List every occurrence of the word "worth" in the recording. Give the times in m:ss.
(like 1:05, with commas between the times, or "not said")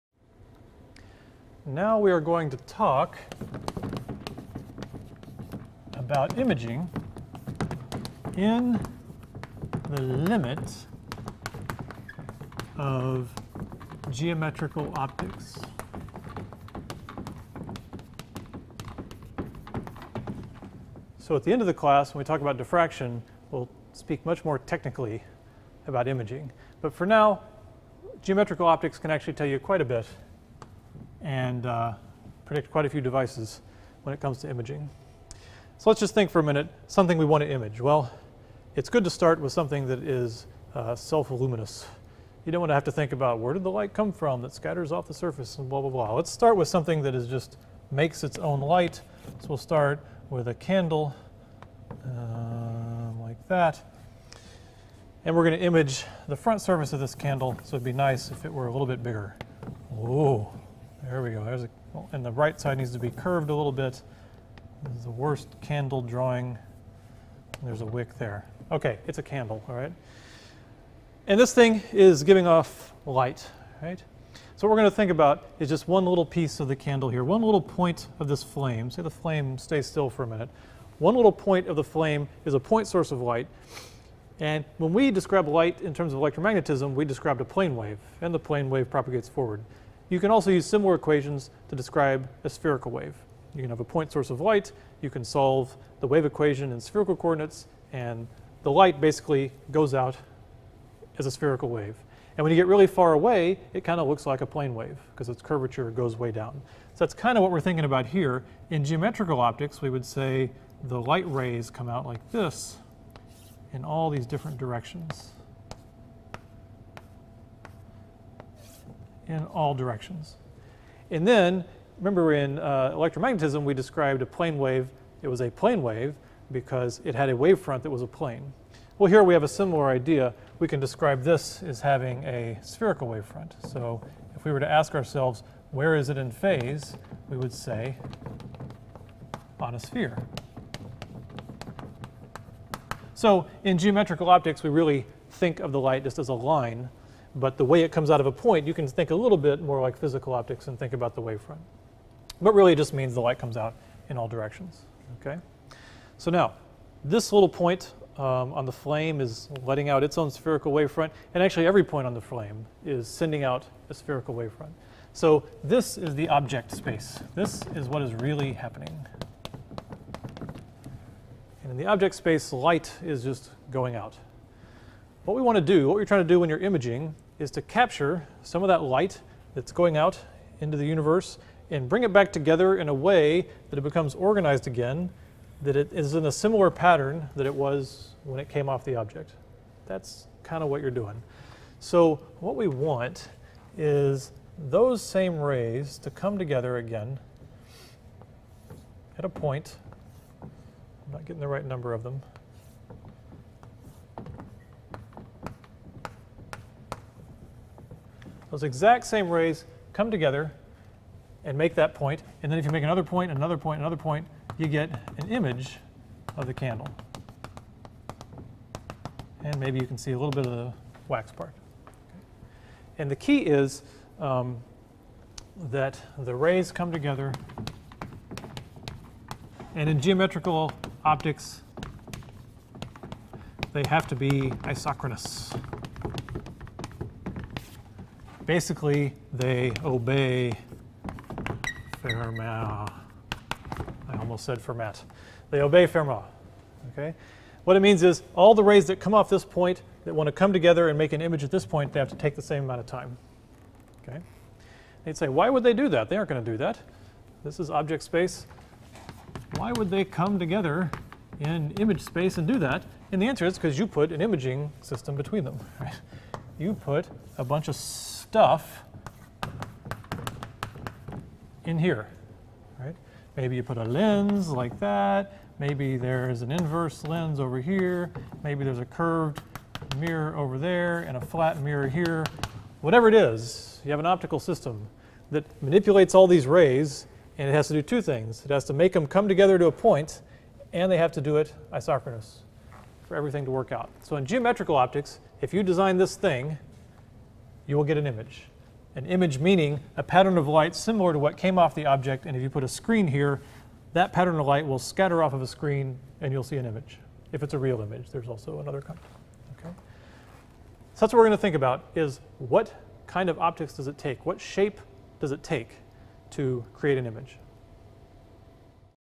not said.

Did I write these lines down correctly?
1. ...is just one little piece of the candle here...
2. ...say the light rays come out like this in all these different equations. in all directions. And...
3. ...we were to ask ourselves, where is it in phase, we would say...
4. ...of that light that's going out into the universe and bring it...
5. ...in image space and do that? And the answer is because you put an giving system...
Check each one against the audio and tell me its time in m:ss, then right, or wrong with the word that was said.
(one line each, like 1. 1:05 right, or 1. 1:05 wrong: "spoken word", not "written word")
1. 1:15 right
2. 1:50 wrong: "directions", not "equations"
3. 2:14 right
4. 2:58 right
5. 4:21 wrong: "imaging", not "giving".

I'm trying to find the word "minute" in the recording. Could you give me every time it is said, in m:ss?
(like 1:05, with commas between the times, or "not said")
0:36, 1:20.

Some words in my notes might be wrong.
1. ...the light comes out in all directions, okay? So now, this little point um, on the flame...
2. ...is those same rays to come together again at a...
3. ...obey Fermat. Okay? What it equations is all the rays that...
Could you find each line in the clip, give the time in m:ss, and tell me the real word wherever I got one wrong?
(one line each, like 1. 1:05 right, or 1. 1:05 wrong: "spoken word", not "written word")
1. 2:33 right
2. 3:13 right
3. 4:05 wrong: "means", not "equations".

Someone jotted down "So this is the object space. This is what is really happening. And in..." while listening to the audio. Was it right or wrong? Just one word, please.
right.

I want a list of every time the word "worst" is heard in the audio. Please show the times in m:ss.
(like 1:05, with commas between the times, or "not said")
1:05.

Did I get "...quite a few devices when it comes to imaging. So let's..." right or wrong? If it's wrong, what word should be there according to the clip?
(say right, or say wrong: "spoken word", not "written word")
right.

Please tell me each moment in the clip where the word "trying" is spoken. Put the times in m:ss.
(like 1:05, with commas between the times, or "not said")
2:56.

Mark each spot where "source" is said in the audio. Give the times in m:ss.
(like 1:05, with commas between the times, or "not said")
1:22, 1:34.